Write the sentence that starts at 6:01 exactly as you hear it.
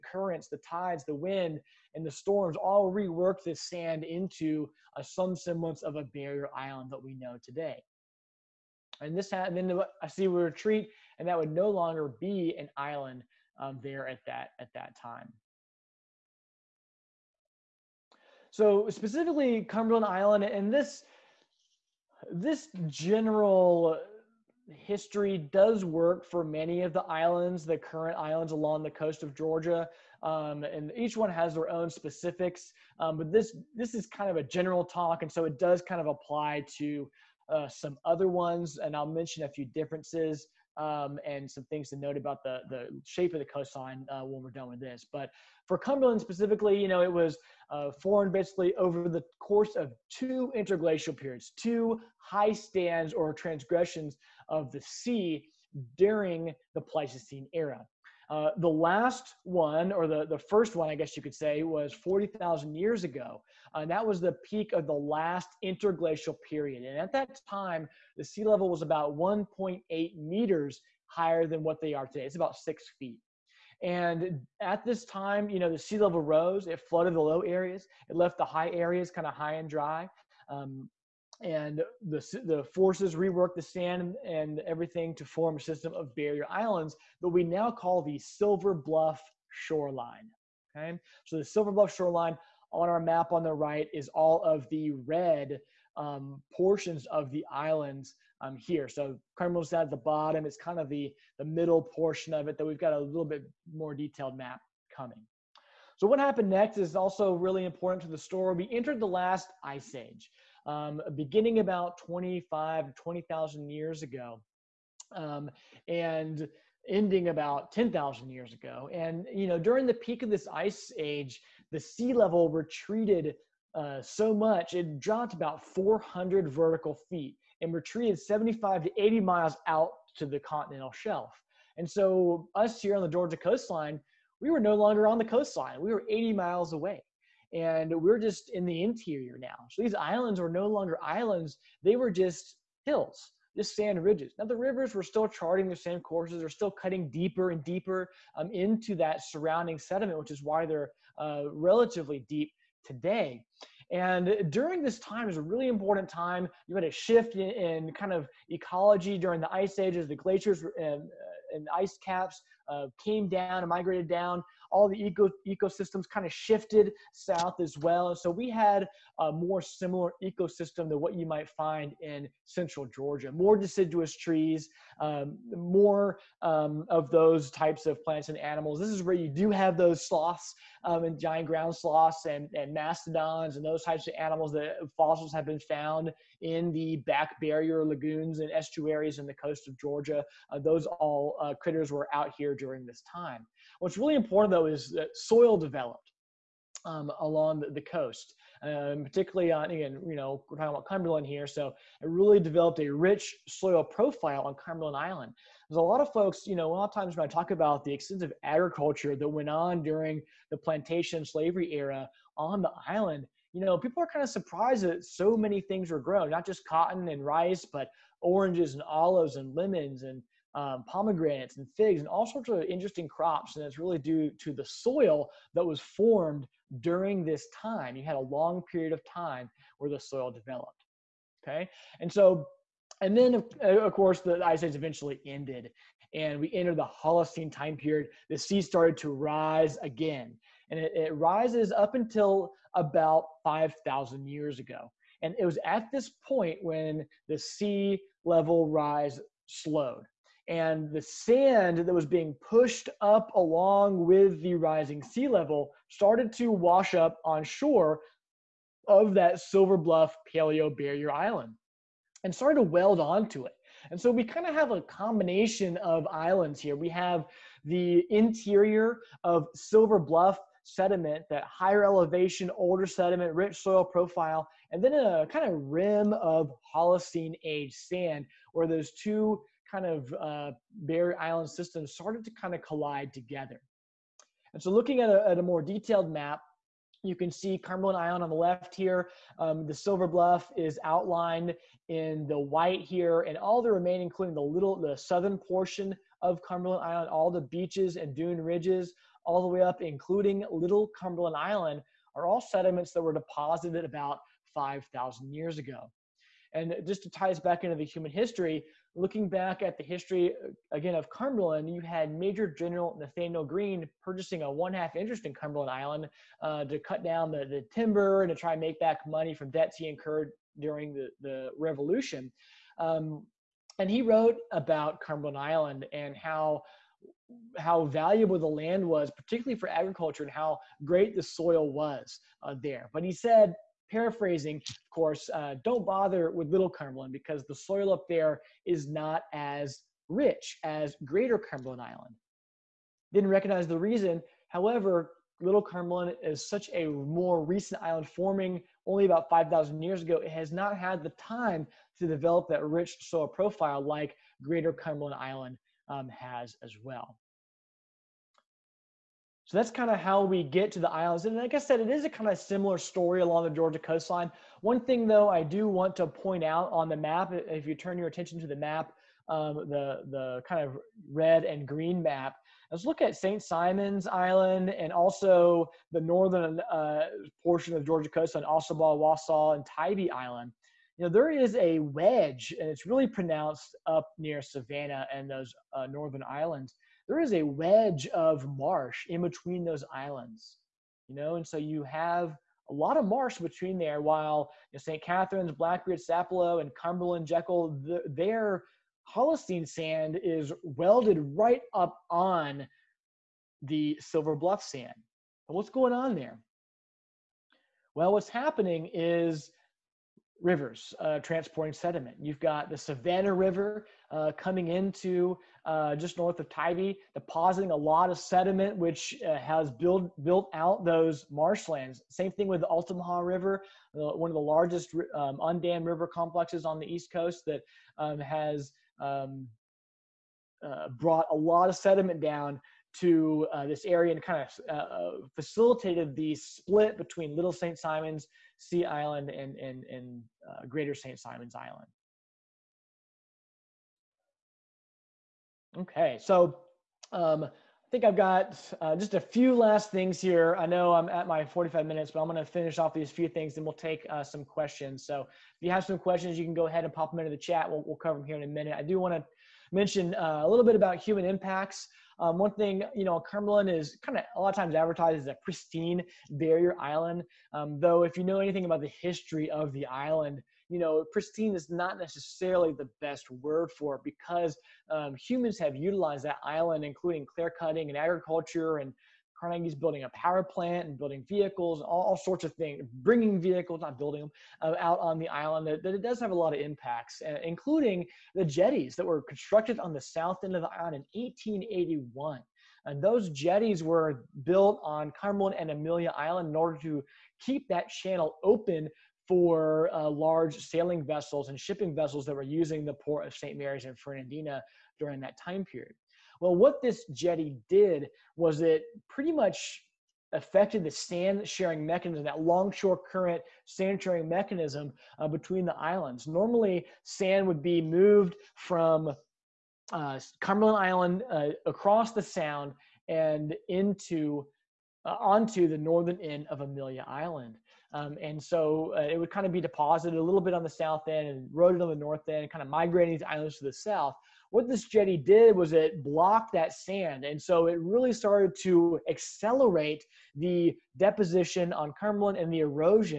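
And like I said, it is a kind of similar story along the Georgia coastline.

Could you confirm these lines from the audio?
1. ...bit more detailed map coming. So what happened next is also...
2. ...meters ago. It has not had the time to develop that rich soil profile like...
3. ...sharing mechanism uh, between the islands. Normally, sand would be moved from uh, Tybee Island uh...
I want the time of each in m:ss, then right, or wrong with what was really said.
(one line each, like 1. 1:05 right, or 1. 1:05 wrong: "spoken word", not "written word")
1. 1:43 right
2. 5:49 wrong: "years", not "meters"
3. 8:34 wrong: "Cumberland", not "Tybee".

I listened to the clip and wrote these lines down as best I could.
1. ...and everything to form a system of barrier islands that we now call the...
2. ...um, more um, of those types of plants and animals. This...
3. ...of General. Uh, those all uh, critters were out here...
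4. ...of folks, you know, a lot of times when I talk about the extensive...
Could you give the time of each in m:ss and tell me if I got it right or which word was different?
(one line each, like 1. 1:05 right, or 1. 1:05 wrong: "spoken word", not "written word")
1. 1:24 right
2. 2:55 right
3. 3:09 wrong: "Georgia", not "General"
4. 3:26 right.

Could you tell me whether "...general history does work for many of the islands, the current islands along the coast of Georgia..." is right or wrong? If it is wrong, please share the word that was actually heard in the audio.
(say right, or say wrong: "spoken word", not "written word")
right.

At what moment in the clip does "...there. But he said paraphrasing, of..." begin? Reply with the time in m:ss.
5:32.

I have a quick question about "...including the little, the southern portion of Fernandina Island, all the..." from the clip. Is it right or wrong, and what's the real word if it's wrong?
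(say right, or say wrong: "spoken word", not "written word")
wrong: "Cumberland", not "Fernandina".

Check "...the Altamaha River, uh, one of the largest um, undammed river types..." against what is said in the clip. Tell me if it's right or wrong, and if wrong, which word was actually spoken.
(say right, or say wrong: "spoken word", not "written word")
wrong: "complexes", not "types".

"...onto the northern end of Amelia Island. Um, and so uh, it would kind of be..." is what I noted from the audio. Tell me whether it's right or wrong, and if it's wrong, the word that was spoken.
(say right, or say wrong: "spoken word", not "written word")
right.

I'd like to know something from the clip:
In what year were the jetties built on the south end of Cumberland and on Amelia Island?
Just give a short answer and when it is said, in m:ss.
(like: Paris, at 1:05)
1881, at 8:11.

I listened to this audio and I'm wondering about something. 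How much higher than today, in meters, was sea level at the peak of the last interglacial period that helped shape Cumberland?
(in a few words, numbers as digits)
1.8 meters.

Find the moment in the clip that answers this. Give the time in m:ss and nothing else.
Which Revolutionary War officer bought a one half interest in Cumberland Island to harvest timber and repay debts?
5:12.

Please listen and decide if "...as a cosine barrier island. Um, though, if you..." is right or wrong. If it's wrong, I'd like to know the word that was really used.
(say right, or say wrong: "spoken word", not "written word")
wrong: "pristine", not "cosine".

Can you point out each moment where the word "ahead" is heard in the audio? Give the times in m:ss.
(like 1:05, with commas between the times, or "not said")
7:36.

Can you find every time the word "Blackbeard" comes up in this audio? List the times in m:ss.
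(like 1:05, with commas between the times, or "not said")
6:35.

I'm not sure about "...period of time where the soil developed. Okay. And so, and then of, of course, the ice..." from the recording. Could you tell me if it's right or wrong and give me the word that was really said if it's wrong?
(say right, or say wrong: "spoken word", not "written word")
right.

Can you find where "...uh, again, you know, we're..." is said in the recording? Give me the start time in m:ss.
3:19.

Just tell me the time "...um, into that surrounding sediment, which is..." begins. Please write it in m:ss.
2:28.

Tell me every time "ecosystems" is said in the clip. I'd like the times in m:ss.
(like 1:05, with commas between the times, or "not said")
2:45, 2:50.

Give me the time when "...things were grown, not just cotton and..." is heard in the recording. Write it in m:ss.
3:35.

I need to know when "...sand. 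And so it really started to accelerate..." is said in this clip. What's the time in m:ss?
8:56.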